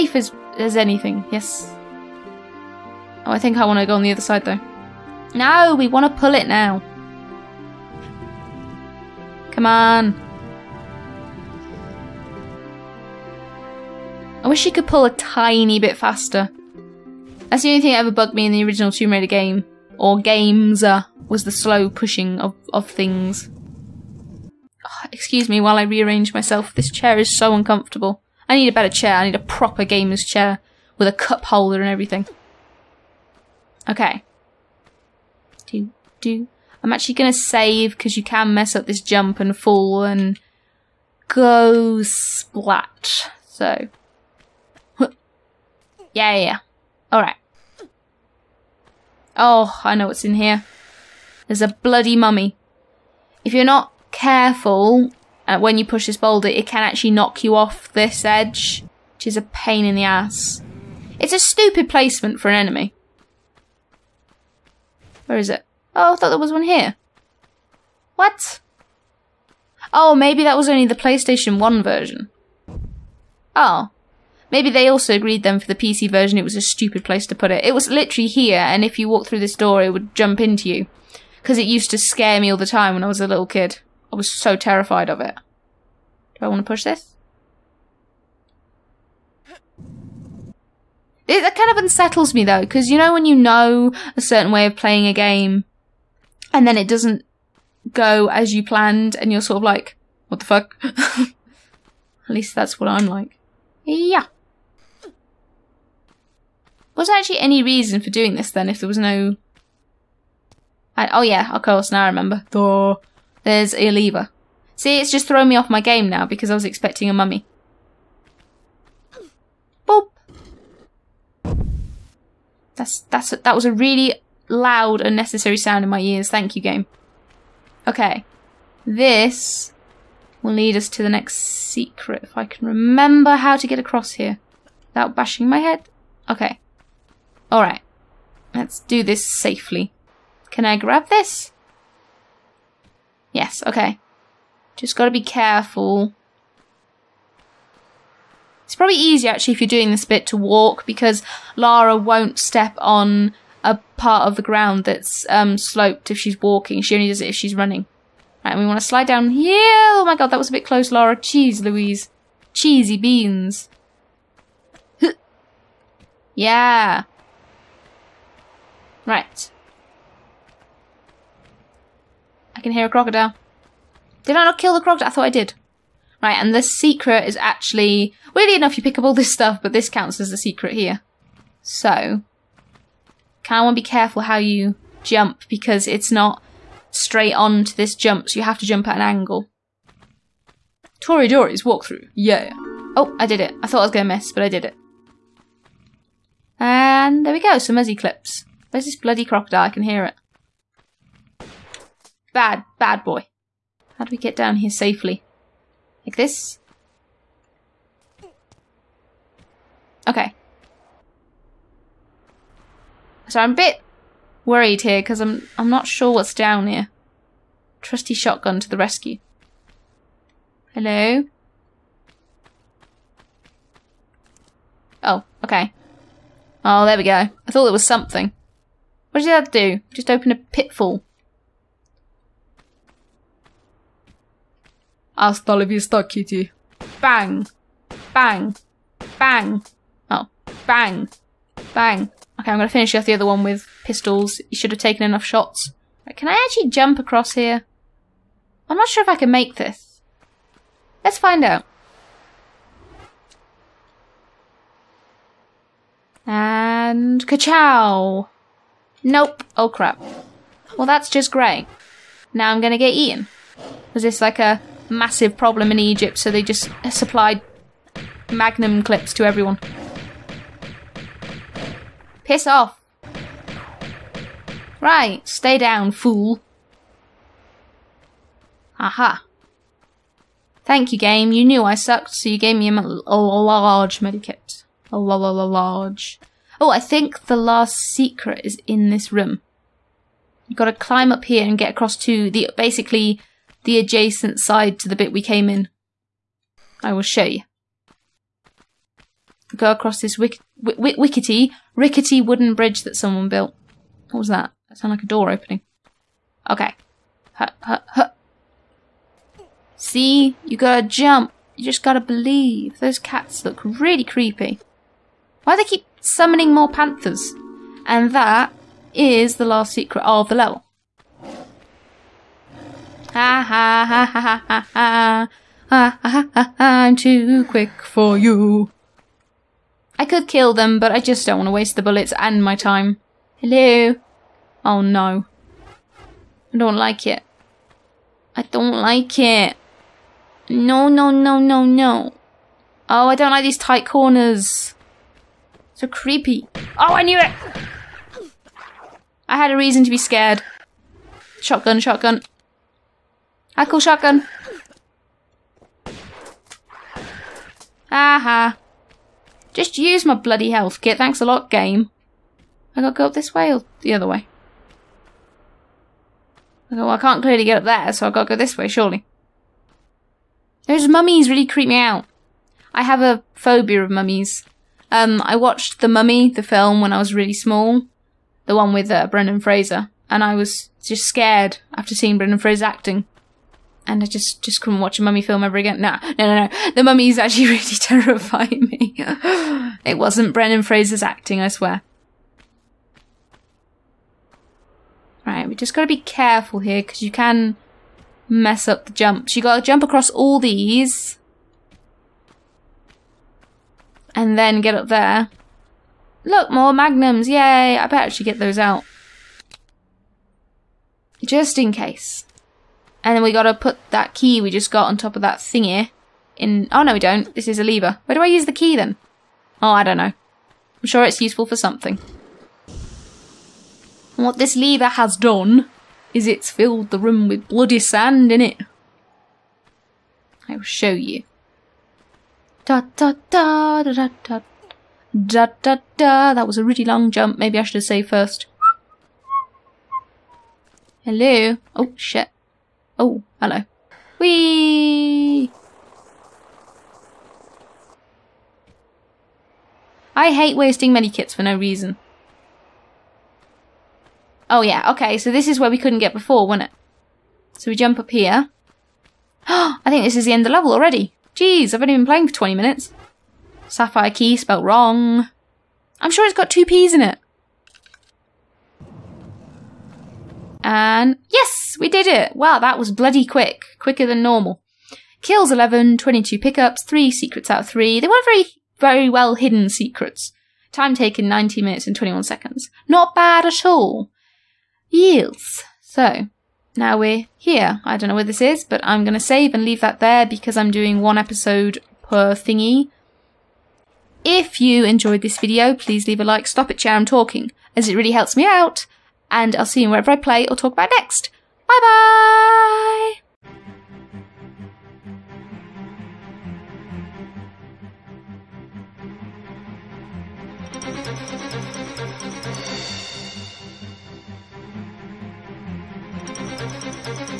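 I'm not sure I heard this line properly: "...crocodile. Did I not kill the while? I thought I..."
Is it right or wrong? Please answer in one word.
wrong.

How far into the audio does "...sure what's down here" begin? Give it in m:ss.
3:35.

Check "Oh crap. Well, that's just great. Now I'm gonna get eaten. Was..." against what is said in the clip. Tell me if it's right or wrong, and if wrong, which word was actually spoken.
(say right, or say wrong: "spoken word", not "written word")
right.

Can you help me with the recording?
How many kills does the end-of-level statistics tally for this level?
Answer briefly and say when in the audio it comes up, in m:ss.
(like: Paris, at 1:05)
11, at 7:55.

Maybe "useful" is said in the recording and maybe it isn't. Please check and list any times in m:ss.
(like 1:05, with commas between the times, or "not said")
7:01.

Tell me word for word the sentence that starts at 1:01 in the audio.
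It's a stupid placement for an enemy.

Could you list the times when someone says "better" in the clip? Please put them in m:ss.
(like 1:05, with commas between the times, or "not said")
0:28, 6:47.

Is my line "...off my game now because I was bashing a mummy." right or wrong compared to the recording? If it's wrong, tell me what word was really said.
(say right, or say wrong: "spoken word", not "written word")
wrong: "expecting", not "bashing".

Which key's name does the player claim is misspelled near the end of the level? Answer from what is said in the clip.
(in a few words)
Sapphire key.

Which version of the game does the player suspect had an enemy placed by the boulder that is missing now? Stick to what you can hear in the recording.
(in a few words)
PlayStation 1.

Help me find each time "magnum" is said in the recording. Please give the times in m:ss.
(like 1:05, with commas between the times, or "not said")
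4:28, 6:46.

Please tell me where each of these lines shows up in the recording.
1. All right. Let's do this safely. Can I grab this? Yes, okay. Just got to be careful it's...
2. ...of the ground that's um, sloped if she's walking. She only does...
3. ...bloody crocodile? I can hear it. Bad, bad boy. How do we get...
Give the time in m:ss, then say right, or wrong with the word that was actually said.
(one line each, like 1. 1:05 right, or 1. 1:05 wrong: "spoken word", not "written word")
1. 2:17 right
2. 2:34 right
3. 3:18 right.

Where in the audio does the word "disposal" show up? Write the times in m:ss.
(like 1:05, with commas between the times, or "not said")
not said.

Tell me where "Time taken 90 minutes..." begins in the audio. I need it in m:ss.
8:00.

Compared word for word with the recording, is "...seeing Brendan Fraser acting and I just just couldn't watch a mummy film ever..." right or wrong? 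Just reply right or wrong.
right.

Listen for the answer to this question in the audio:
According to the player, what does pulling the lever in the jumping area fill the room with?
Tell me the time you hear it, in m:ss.
7:07.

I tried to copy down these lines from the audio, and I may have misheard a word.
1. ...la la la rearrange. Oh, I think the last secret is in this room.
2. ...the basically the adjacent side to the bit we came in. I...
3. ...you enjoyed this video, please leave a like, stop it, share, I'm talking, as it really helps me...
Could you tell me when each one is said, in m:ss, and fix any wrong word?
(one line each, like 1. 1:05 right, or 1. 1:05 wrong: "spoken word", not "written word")
1. 4:44 wrong: "large", not "rearrange"
2. 4:52 right
3. 8:14 right.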